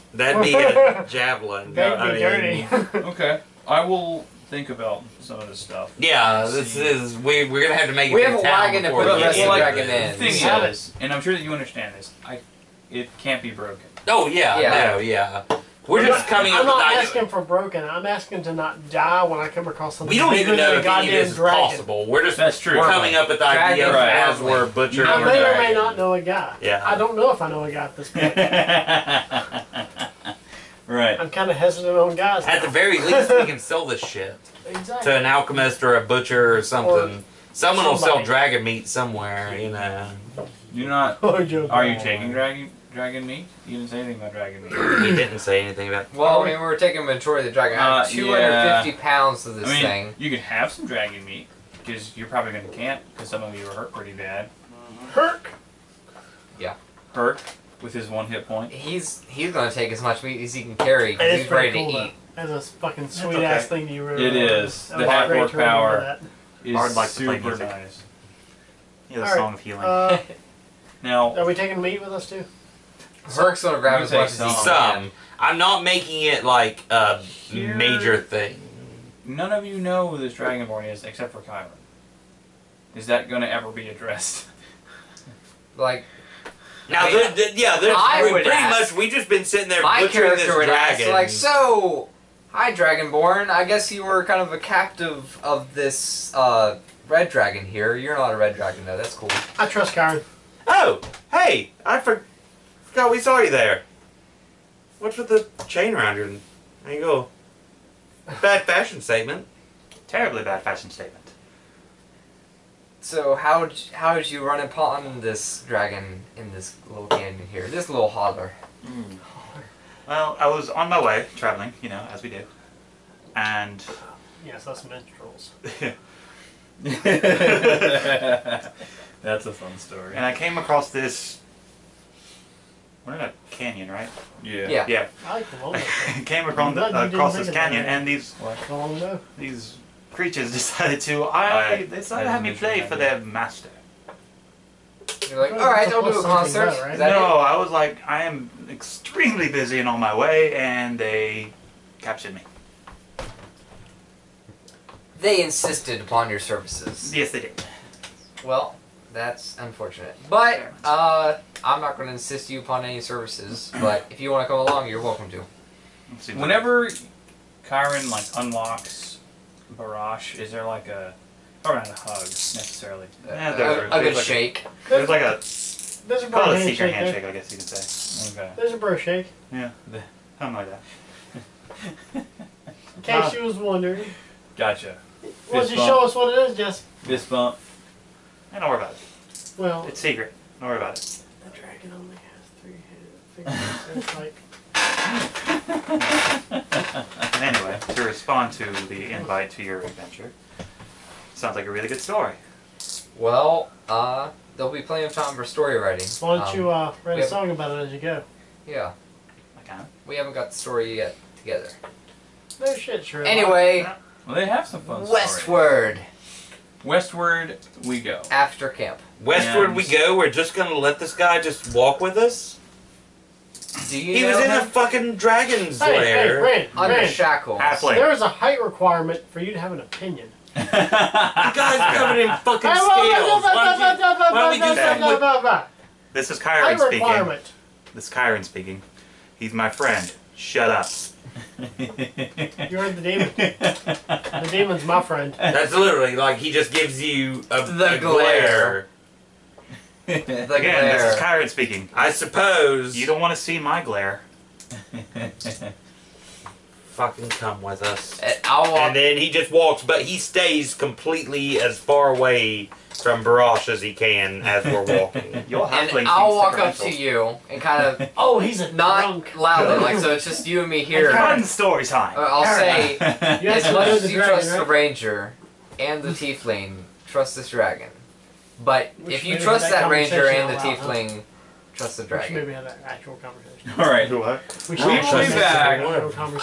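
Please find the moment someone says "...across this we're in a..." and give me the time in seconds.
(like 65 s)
130 s.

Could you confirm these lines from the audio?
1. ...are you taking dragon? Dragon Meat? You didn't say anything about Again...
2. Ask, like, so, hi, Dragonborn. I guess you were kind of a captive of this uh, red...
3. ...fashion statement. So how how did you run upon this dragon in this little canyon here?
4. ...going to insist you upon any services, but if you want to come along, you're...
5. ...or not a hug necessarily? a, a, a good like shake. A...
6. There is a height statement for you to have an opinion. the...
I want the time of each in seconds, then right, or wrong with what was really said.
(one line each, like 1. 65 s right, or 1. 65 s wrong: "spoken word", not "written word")
1. 41 s wrong: "Dragon", not "Again"
2. 91 s right
3. 110 s right
4. 161 s right
5. 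171 s right
6. 227 s wrong: "requirement", not "statement".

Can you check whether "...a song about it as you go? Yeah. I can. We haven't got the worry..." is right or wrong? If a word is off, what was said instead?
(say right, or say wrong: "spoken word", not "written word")
wrong: "story", not "worry".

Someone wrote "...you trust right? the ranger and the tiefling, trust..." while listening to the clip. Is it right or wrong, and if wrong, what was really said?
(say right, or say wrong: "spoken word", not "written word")
right.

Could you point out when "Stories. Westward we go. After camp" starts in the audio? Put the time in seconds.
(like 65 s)
215 s.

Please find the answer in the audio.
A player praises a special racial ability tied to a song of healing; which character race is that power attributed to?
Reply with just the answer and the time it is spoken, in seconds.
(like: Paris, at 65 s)
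half orc, at 65 s.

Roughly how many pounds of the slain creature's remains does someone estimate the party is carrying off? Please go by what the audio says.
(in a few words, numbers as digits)
250.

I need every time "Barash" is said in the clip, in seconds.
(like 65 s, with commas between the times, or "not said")
169 s, 263 s.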